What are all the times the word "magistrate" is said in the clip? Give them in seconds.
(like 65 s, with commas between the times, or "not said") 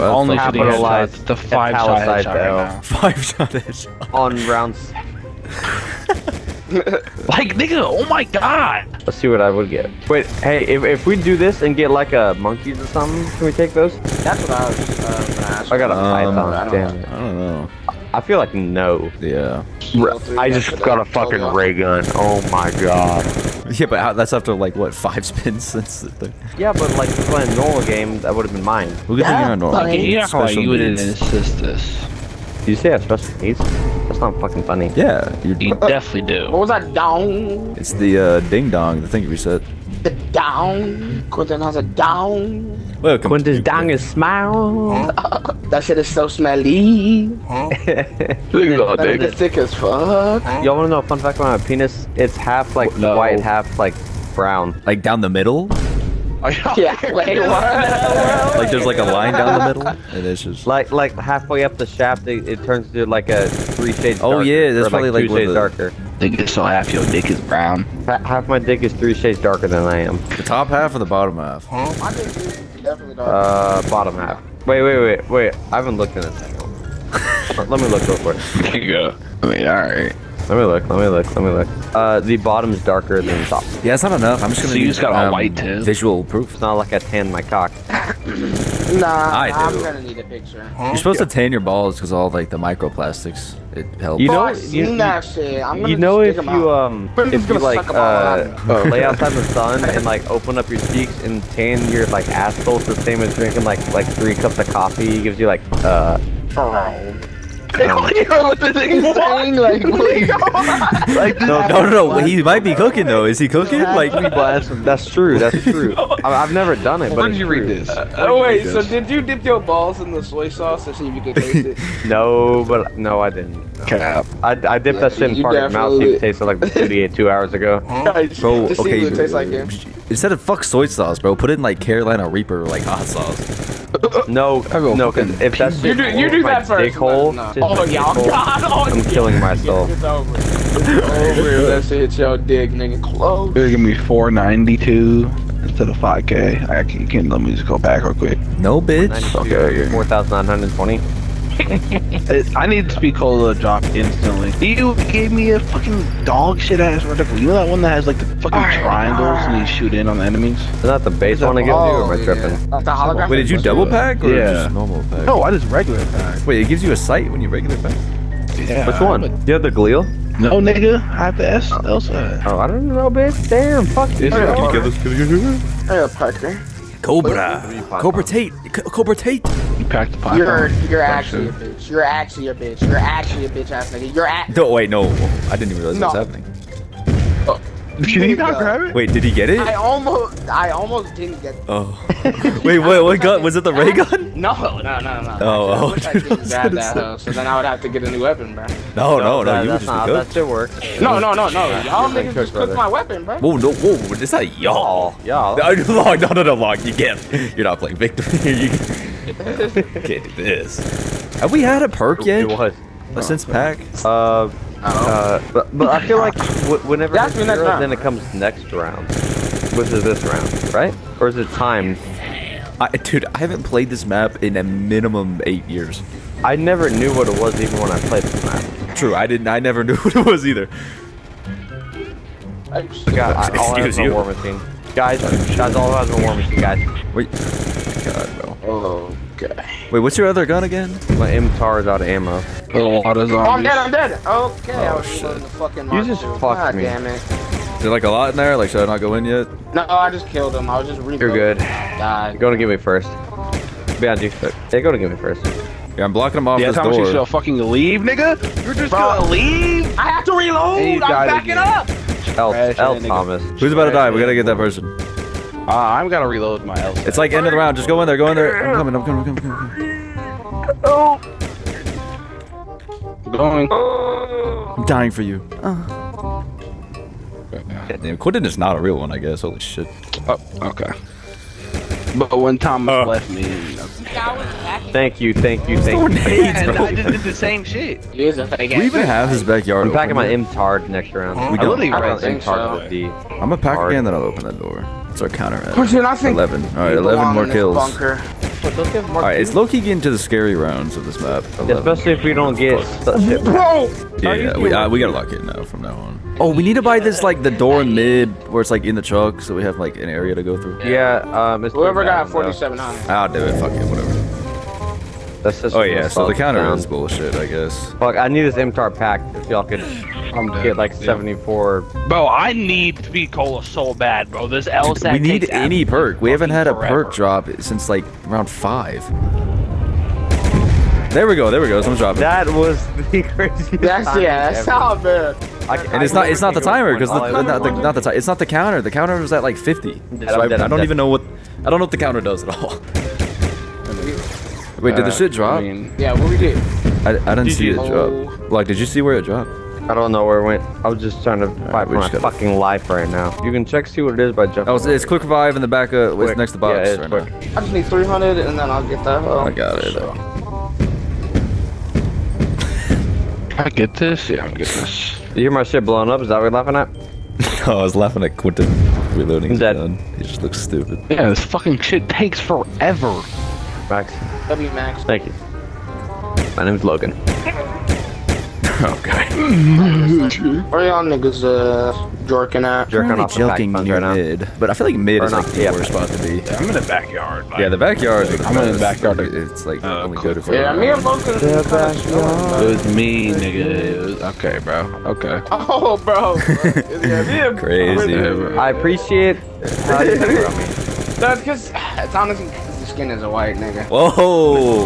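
not said.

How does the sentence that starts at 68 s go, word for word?
half my dick is three shades darker than I am.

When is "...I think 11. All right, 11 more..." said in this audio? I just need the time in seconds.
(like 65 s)
295 s.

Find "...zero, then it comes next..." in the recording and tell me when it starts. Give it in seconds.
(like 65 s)
217 s.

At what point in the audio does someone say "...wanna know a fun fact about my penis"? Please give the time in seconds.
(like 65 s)
50 s.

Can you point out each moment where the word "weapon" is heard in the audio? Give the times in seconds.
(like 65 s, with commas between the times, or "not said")
198 s, 202 s.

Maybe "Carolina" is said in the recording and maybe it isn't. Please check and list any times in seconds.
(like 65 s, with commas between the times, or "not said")
131 s.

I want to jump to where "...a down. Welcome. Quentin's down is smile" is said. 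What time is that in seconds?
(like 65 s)
41 s.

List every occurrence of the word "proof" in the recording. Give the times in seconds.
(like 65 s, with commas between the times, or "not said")
86 s.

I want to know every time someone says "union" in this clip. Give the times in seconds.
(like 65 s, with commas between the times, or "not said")
not said.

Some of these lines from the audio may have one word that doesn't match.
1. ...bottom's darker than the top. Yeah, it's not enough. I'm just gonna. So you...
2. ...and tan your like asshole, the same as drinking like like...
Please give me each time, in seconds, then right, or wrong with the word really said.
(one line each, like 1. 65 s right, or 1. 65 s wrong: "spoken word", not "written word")
1. 82 s right
2. 101 s right.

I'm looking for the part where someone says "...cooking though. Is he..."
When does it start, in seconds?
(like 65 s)
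112 s.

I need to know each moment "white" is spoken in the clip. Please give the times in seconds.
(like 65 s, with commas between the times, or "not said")
53 s, 85 s, 403 s.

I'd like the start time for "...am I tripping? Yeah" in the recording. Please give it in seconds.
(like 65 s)
162 s.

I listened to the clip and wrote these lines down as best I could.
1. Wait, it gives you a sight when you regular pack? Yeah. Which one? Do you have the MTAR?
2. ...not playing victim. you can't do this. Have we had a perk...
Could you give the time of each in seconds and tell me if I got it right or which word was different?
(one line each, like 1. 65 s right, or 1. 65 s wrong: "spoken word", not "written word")
1. 166 s wrong: "Gleal", not "MTAR"
2. 207 s right.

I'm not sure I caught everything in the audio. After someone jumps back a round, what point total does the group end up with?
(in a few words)
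4,920.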